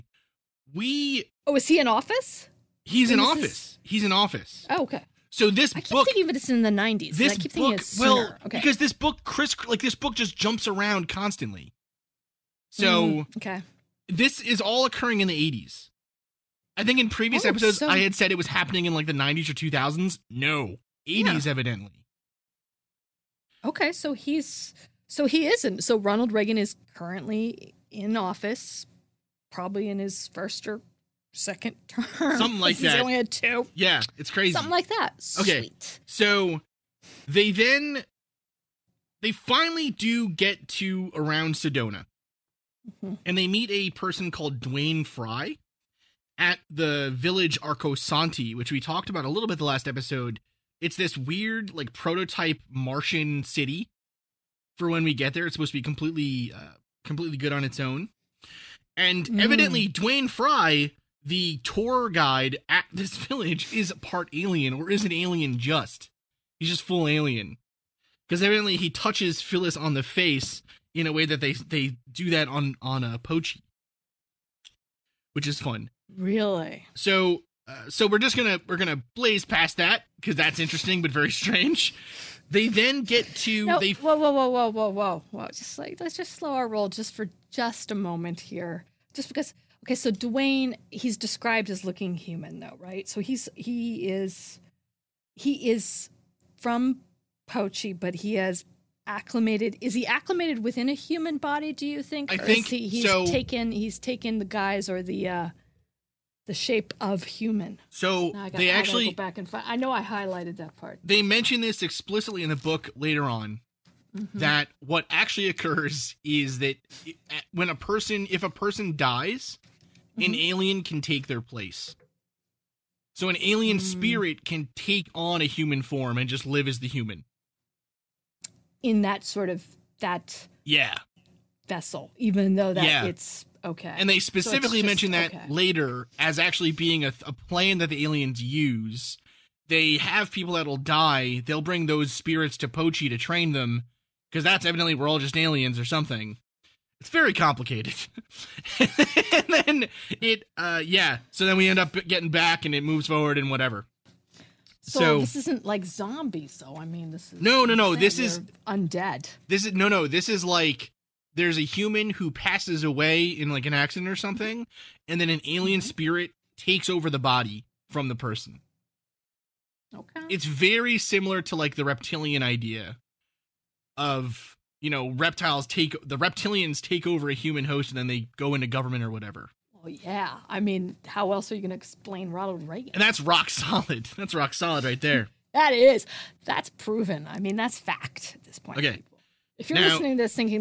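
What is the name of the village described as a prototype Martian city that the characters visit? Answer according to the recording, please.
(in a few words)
Arcosanti.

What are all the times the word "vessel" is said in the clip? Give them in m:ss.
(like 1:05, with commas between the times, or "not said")
2:11.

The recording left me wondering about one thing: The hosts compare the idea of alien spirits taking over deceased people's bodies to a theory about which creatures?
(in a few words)
reptilians.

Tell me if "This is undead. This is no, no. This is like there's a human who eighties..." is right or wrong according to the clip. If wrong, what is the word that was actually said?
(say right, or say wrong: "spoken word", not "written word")
wrong: "passes", not "eighties".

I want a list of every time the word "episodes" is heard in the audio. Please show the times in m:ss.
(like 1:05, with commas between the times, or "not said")
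0:17, 0:49.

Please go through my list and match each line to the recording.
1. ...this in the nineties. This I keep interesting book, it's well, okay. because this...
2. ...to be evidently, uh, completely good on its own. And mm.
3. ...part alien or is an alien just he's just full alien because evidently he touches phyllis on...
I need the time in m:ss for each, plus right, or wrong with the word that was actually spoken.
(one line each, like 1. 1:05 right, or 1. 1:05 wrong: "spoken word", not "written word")
1. 0:06 wrong: "thinking", not "interesting"
2. 0:55 wrong: "completely", not "evidently"
3. 1:04 right.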